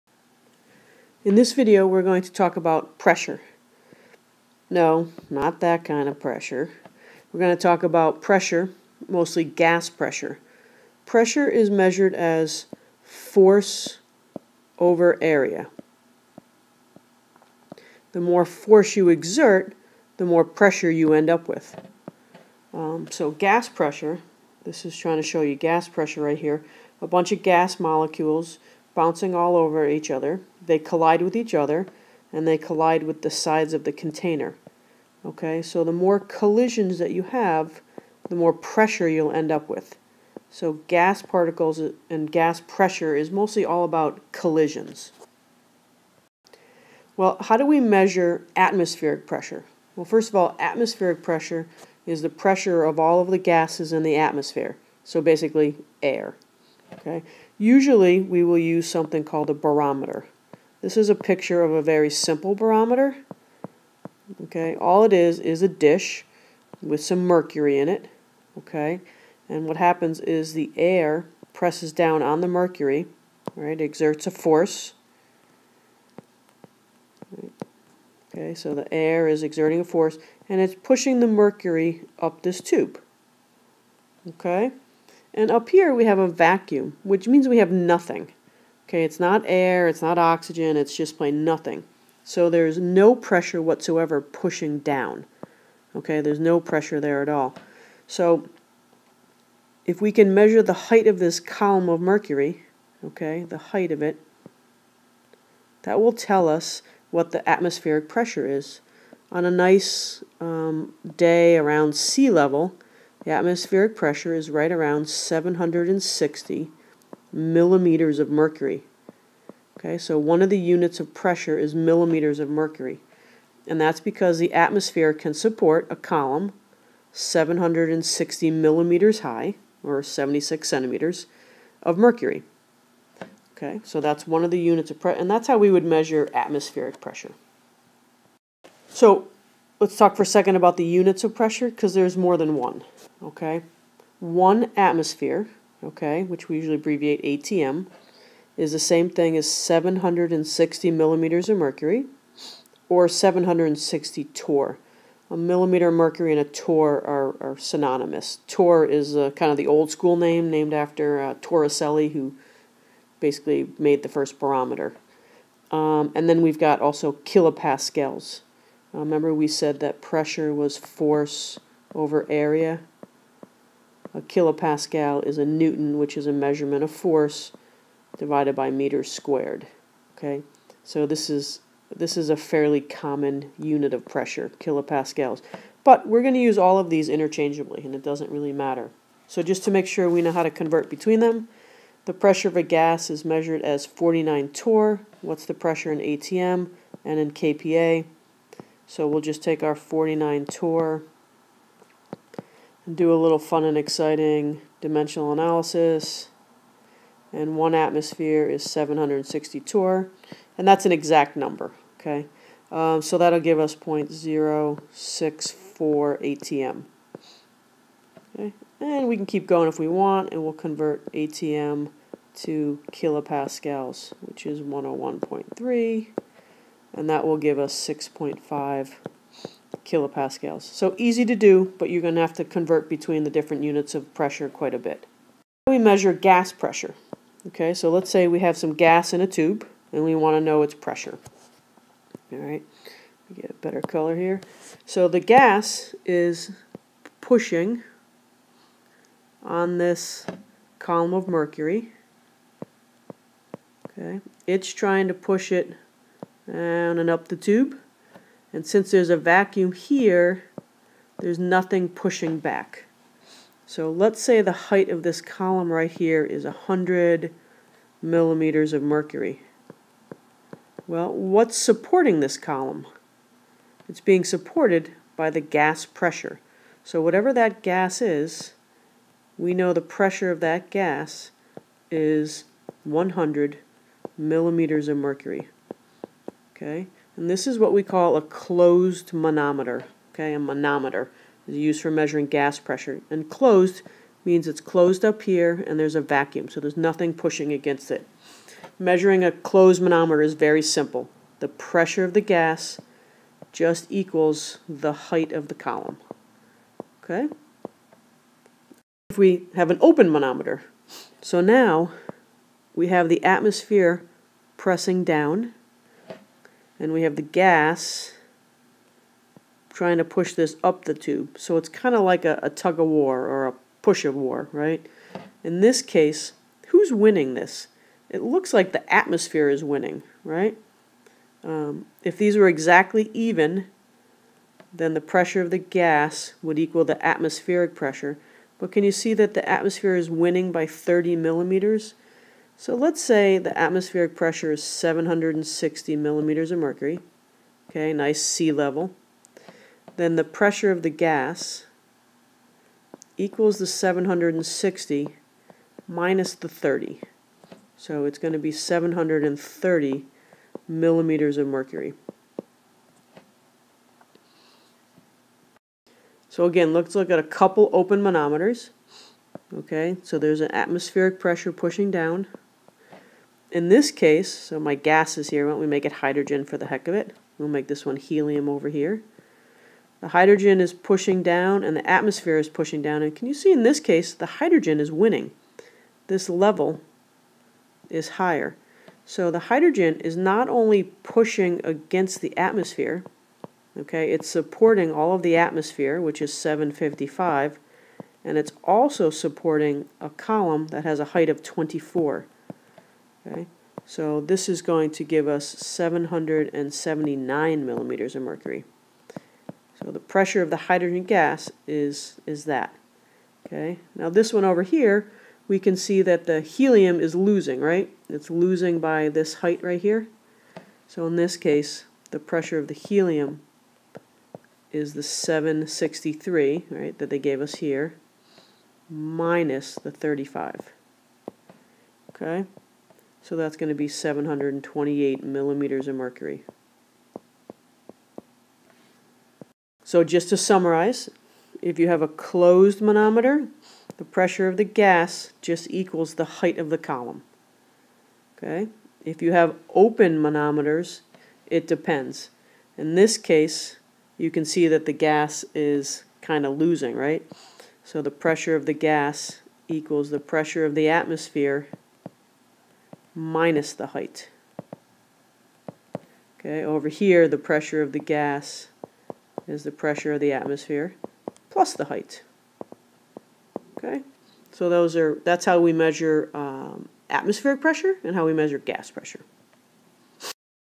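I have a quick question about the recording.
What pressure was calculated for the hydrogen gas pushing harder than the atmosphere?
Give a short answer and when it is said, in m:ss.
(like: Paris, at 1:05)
779 millimeters of mercury, at 6:45.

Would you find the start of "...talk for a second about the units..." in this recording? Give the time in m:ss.
2:19.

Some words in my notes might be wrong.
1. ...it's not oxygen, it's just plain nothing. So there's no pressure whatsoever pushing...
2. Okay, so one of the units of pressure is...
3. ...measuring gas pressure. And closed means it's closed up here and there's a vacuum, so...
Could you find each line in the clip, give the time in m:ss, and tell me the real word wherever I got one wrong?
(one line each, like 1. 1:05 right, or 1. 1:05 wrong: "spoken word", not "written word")
1. 1:29 right
2. 1:59 right
3. 4:51 right.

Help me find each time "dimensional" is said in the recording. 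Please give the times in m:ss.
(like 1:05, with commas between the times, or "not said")
3:24.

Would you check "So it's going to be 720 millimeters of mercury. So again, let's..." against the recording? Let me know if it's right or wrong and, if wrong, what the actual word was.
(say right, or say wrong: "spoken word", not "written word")
wrong: "730", not "720".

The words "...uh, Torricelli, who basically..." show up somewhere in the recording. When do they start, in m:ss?
2:41.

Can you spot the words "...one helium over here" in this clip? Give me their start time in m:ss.
6:17.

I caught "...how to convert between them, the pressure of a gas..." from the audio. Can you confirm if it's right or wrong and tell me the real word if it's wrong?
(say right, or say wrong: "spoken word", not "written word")
right.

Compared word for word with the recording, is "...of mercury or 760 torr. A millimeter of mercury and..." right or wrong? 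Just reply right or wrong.
right.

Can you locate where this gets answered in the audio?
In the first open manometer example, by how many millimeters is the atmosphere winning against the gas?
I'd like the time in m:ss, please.
5:40.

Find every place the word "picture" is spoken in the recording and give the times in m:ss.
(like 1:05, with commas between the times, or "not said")
1:01.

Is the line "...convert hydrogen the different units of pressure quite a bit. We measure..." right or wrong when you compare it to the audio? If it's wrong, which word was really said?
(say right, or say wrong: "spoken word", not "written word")
wrong: "between", not "hydrogen".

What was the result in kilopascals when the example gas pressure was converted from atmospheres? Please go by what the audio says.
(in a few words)
6.5 kilopascals.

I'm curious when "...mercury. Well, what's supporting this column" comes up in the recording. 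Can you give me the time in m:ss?
4:28.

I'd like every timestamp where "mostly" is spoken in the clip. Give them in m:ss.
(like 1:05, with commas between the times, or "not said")
0:09, 0:43.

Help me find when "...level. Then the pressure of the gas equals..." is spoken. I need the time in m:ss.
5:48.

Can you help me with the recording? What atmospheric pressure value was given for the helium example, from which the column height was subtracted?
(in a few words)
763.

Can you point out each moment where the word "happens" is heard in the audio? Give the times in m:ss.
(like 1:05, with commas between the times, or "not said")
1:09.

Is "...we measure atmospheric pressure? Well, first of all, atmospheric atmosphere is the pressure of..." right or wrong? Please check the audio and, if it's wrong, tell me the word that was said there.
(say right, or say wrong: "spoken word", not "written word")
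wrong: "pressure", not "atmosphere".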